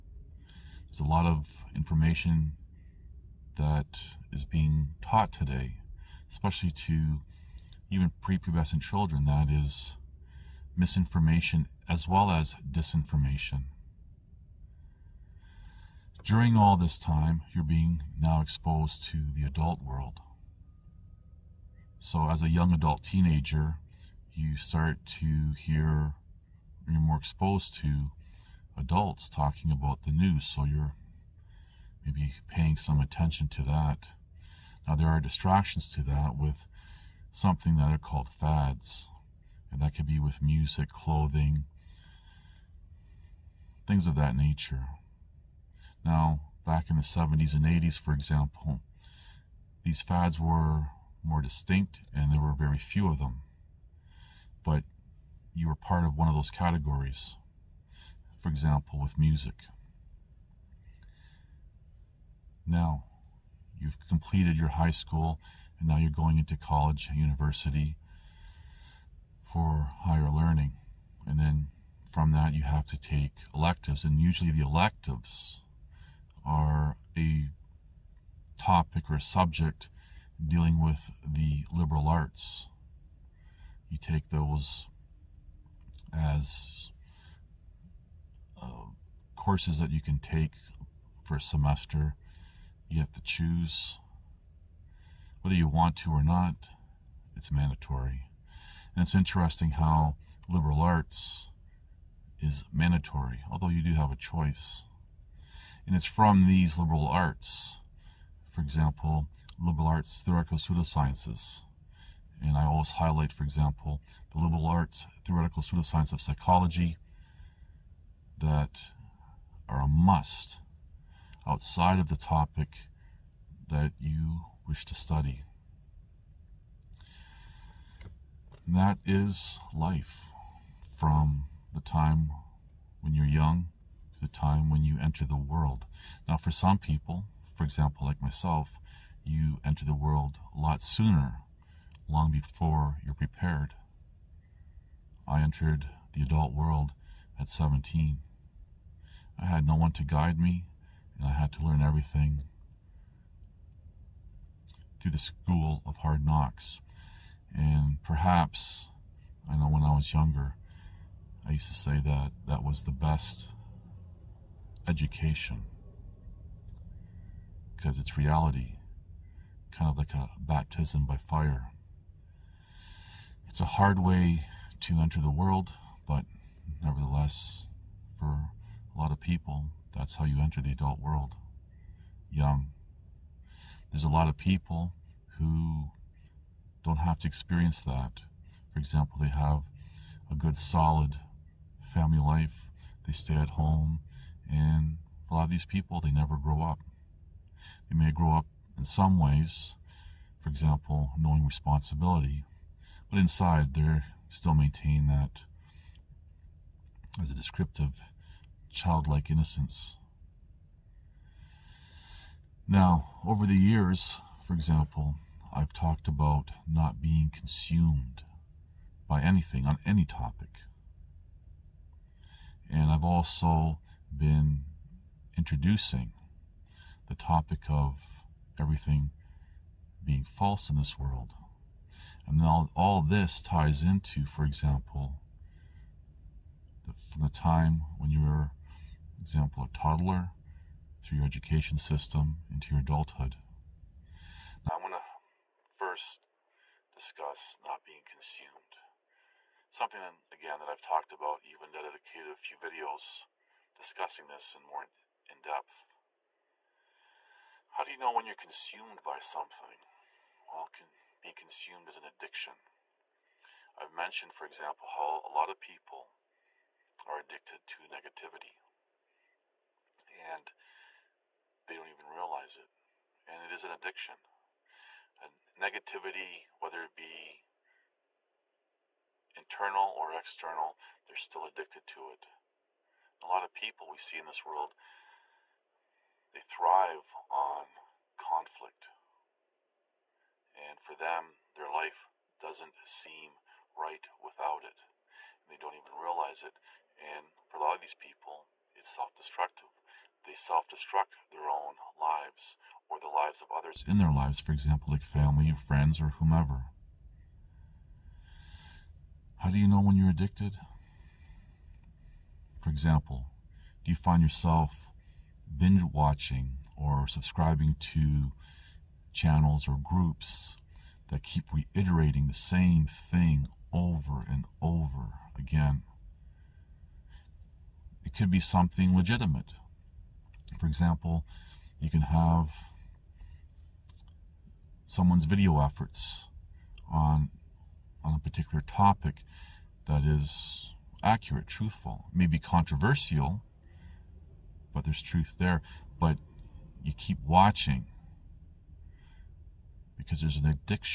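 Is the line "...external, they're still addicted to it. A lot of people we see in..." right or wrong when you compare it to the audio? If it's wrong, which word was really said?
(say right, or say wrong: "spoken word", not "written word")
right.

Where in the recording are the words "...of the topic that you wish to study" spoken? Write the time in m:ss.
2:01.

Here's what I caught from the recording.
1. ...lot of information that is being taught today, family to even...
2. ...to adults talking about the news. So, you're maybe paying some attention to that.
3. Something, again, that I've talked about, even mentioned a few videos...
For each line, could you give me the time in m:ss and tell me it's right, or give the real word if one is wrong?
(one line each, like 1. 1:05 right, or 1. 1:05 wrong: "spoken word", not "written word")
1. 0:01 wrong: "especially", not "family"
2. 0:27 right
3. 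4:09 wrong: "dedicated", not "mentioned".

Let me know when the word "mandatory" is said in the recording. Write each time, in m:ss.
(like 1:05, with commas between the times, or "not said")
1:37, 1:42.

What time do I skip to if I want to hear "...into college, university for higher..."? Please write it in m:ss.
1:06.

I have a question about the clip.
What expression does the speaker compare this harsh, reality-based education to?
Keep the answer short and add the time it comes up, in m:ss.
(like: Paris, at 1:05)
Baptism by fire, at 2:50.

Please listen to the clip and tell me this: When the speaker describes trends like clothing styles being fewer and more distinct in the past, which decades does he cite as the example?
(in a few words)
70s and 80s.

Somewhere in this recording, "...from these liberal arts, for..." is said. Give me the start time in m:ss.
1:46.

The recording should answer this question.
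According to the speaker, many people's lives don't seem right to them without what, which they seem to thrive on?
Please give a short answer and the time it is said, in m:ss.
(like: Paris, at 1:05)
Conflict, at 4:48.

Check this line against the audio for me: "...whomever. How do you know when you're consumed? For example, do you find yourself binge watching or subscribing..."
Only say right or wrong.
wrong.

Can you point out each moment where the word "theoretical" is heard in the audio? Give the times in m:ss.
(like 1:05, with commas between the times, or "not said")
1:50, 1:55.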